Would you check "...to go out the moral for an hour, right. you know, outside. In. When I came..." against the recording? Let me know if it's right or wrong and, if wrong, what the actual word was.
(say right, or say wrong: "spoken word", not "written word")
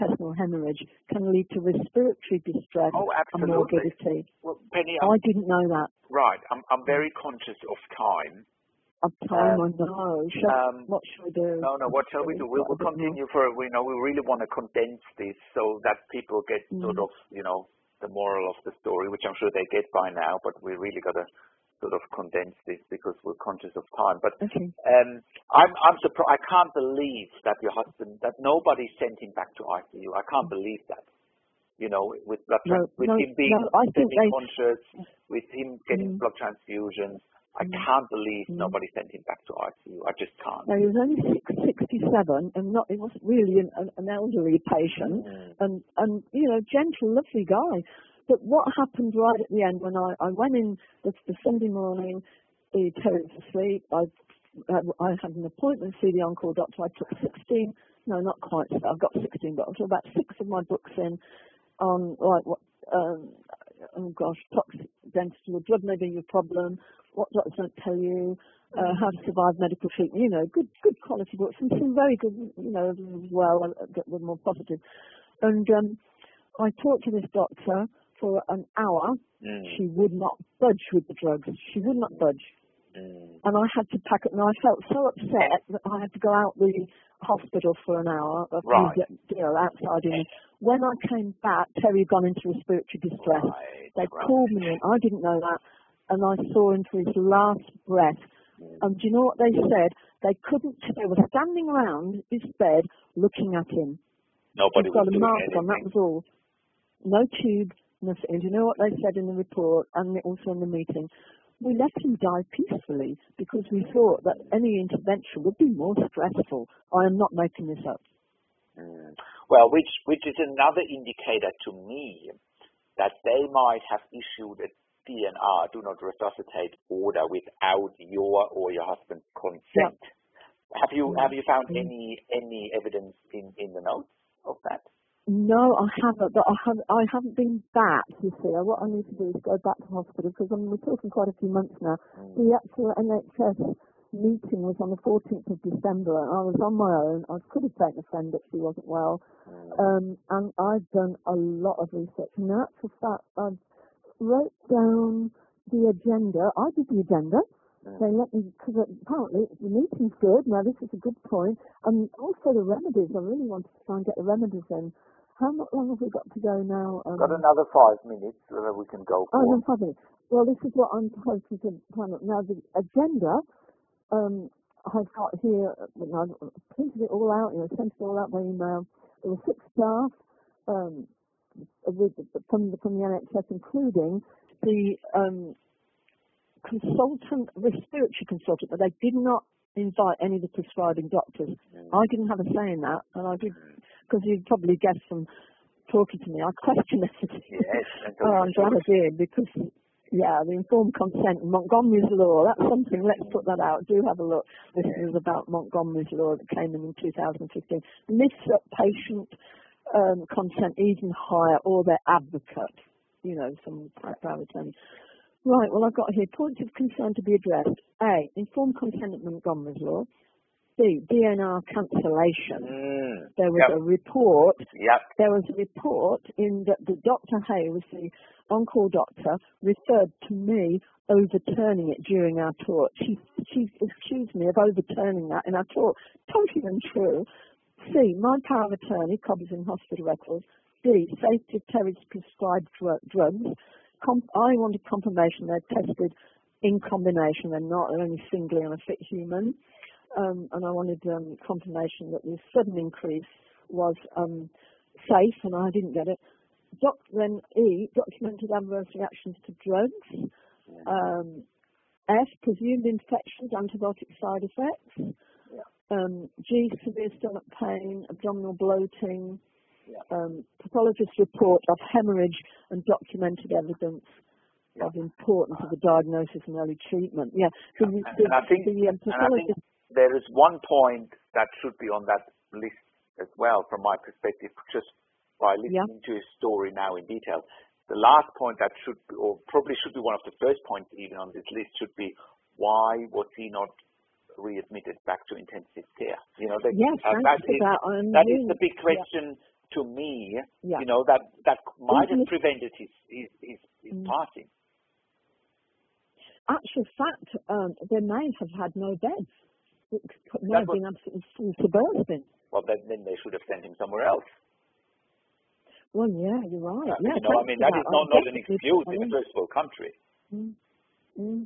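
wrong: "hospital", not "moral".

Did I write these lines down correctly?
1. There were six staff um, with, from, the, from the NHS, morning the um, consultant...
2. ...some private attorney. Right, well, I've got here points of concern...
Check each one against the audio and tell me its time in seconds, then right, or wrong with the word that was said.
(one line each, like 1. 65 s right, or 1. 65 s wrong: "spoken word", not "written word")
1. 179 s wrong: "including", not "morning"
2. 213 s right.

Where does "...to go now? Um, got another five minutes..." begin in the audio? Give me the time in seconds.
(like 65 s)
166 s.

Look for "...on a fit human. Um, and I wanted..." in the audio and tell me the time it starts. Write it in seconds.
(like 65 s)
248 s.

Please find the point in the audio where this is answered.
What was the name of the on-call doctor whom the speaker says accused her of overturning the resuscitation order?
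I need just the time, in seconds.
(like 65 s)
227 s.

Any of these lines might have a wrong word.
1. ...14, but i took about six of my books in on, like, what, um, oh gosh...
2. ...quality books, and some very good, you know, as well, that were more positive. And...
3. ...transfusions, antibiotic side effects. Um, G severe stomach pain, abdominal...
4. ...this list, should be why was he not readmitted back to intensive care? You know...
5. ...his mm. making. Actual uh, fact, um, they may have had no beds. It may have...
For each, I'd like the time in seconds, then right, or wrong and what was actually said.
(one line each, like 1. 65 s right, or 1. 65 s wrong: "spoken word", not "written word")
1. 59 s wrong: "16", not "14"
2. 71 s right
3. 262 s wrong: "infections", not "transfusions"
4. 291 s right
5. 303 s wrong: "passing", not "making".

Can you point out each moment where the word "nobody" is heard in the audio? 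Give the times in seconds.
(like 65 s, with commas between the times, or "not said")
28 s, 38 s, 104 s.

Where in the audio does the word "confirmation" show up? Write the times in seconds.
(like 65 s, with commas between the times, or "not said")
244 s, 251 s.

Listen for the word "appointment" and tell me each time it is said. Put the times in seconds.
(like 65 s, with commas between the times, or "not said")
55 s.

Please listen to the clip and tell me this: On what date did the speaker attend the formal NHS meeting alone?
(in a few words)
14th of December.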